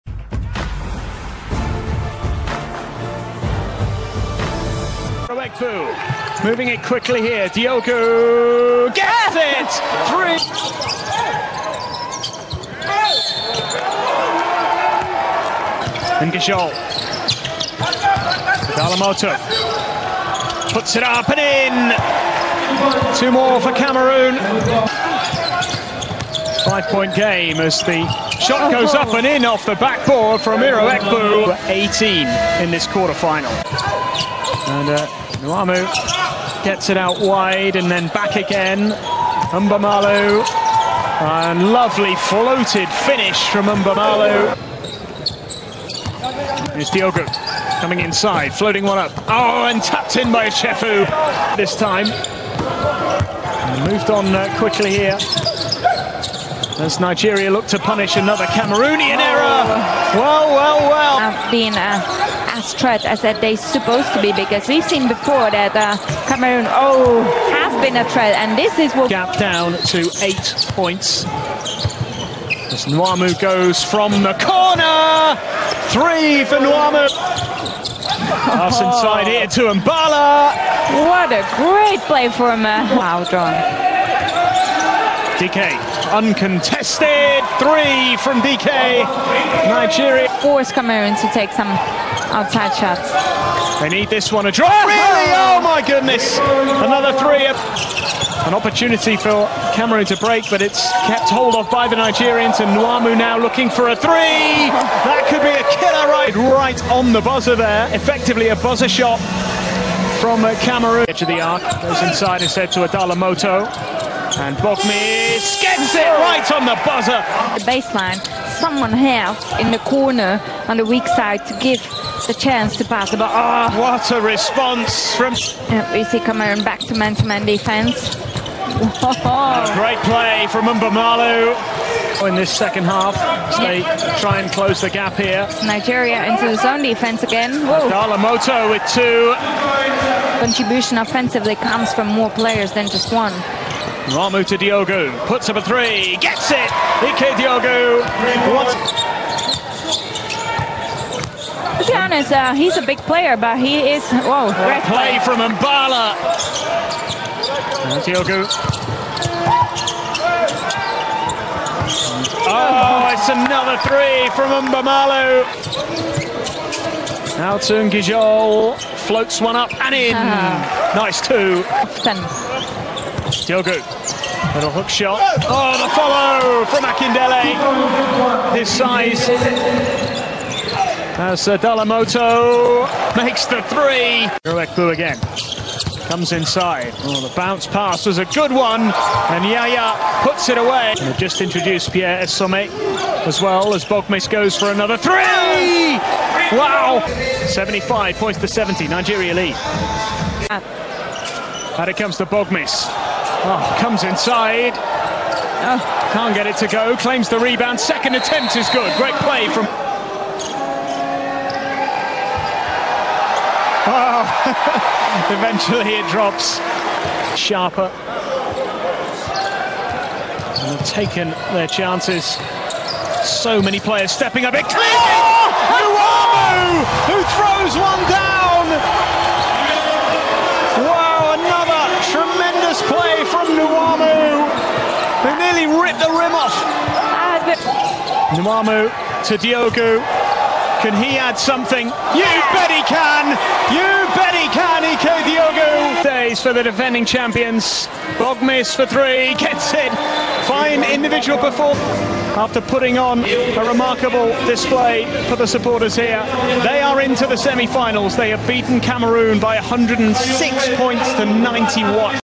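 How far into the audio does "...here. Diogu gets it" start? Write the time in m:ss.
0:07.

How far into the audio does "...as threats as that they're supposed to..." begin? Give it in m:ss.
1:02.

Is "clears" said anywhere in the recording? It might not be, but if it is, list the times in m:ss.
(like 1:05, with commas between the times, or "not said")
3:44.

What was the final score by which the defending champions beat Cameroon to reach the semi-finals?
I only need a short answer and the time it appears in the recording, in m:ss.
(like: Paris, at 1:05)
106 to 91, at 4:19.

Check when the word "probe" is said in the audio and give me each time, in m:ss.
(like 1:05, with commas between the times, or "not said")
not said.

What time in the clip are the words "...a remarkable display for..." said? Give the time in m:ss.
4:13.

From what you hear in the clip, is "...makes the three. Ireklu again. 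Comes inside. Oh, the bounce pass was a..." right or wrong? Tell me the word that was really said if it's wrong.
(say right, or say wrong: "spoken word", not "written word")
right.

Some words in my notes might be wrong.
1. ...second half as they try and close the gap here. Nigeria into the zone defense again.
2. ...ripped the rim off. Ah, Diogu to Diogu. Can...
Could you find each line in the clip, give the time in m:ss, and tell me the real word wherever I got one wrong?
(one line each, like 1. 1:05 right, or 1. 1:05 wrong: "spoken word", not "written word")
1. 2:12 right
2. 3:55 wrong: "Nwamu", not "Diogu".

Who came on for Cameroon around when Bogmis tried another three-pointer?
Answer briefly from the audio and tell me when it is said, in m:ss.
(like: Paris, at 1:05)
Pierre Essome, at 3:11.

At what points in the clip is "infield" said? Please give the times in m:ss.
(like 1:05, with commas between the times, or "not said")
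not said.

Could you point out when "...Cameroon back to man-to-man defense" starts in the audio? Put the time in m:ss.
2:06.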